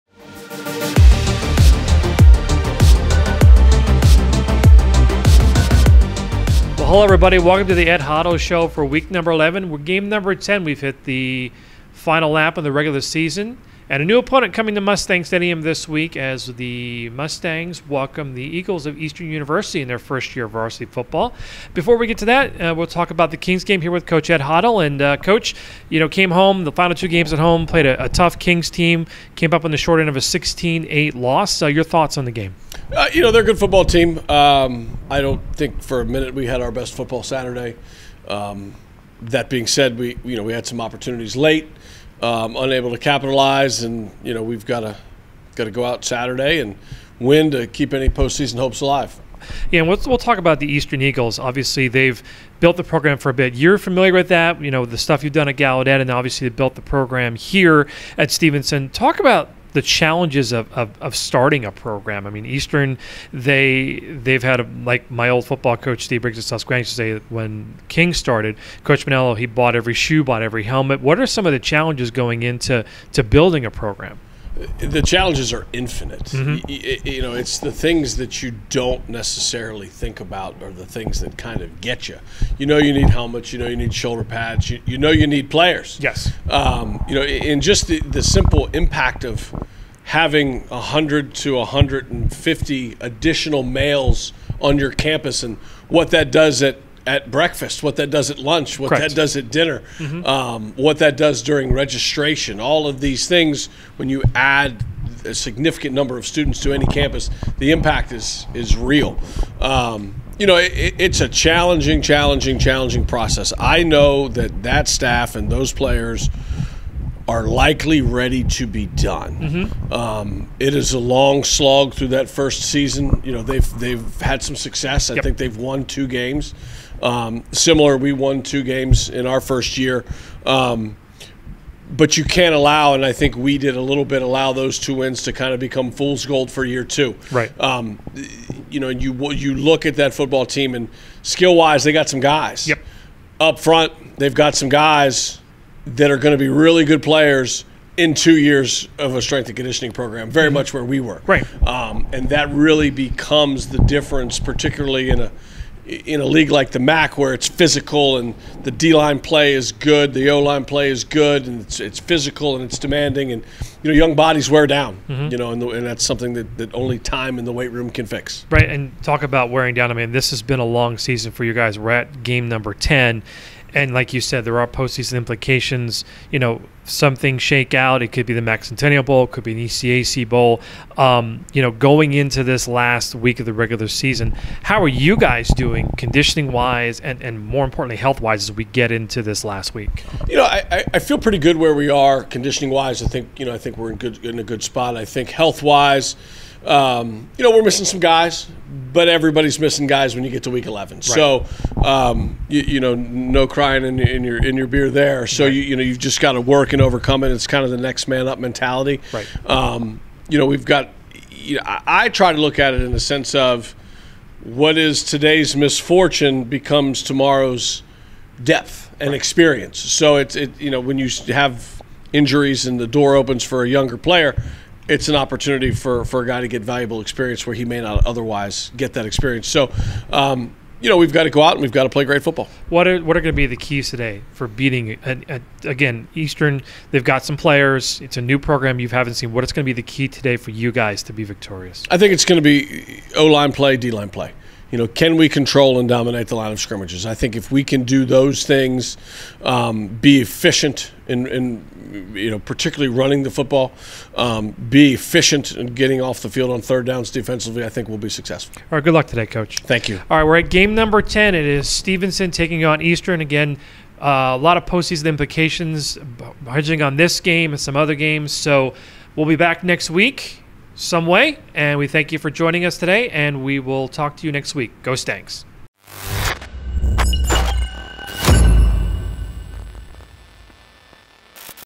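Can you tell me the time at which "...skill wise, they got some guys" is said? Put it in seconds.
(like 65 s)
141 s.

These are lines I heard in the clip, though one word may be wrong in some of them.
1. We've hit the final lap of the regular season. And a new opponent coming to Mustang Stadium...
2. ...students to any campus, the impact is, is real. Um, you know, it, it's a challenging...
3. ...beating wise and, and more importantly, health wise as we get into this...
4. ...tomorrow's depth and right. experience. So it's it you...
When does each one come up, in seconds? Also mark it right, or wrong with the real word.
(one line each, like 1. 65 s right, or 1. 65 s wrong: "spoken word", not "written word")
1. 10 s right
2. 106 s right
3. 185 s wrong: "conditioning", not "beating"
4. 217 s right.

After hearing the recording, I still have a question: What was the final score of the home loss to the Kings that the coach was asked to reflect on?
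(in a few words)
16-8.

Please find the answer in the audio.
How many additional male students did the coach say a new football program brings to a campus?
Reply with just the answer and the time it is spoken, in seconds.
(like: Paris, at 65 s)
100 to 150, at 90 s.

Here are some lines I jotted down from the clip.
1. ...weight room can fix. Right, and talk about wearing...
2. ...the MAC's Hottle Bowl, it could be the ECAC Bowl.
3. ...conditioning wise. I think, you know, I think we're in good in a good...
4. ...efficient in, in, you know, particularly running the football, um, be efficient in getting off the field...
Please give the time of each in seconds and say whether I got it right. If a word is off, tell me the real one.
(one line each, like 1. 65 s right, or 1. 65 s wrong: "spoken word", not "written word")
1. 167 s right
2. 178 s wrong: "Centennial", not "Hottle"
3. 192 s right
4. 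250 s right.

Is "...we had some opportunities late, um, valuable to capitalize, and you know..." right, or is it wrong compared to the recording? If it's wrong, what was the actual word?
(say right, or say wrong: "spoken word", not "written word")
wrong: "unable", not "valuable".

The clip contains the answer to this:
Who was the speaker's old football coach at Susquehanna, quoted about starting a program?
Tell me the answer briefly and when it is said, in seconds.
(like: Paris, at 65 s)
Steve Briggs, at 66 s.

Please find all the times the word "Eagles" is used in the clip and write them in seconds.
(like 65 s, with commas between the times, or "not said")
18 s, 51 s.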